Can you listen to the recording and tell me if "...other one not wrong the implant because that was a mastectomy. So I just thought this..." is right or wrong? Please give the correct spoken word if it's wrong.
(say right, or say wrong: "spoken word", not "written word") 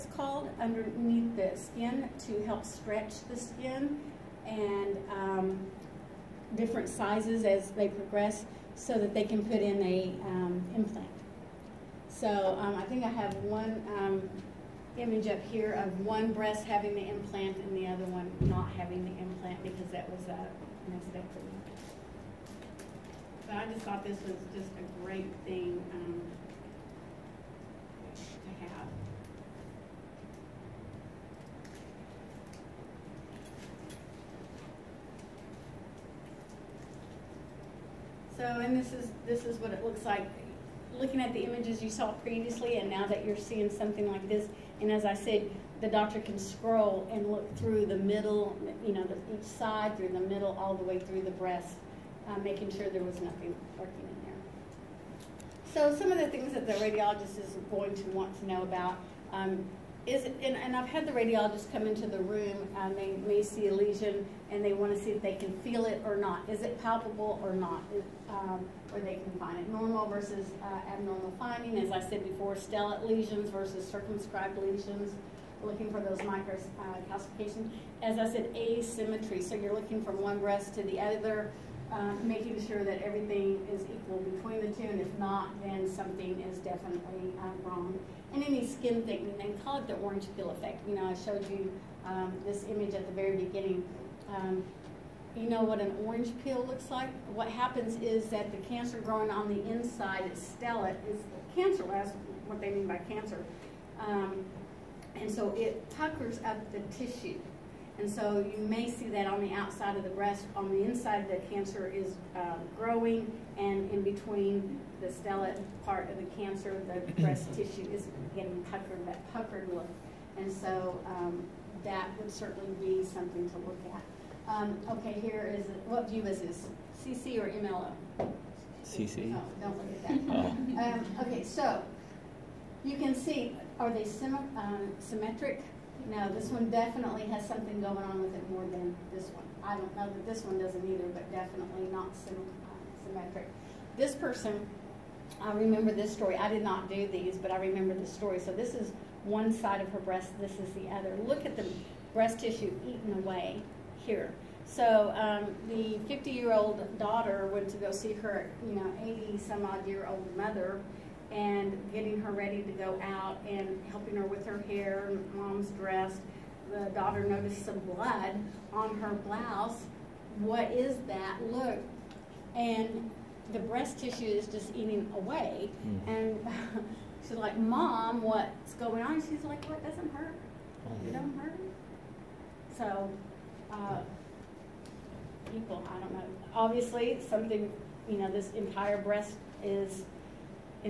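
wrong: "having", not "wrong".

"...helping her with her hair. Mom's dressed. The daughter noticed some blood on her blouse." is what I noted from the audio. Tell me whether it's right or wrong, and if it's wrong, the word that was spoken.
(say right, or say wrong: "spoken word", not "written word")
right.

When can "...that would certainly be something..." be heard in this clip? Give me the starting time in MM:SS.
02:01.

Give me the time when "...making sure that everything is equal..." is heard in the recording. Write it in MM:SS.
01:22.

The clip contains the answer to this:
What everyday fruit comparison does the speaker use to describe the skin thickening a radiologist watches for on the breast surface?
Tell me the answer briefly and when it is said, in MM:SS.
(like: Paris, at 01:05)
orange peel effect, at 01:29.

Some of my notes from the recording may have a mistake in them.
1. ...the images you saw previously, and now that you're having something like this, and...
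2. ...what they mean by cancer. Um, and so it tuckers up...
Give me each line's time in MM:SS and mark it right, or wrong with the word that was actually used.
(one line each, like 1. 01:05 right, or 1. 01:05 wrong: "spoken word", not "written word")
1. 00:41 wrong: "seeing", not "having"
2. 01:42 right.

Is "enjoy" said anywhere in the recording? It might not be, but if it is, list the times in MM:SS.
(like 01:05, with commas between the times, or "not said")
not said.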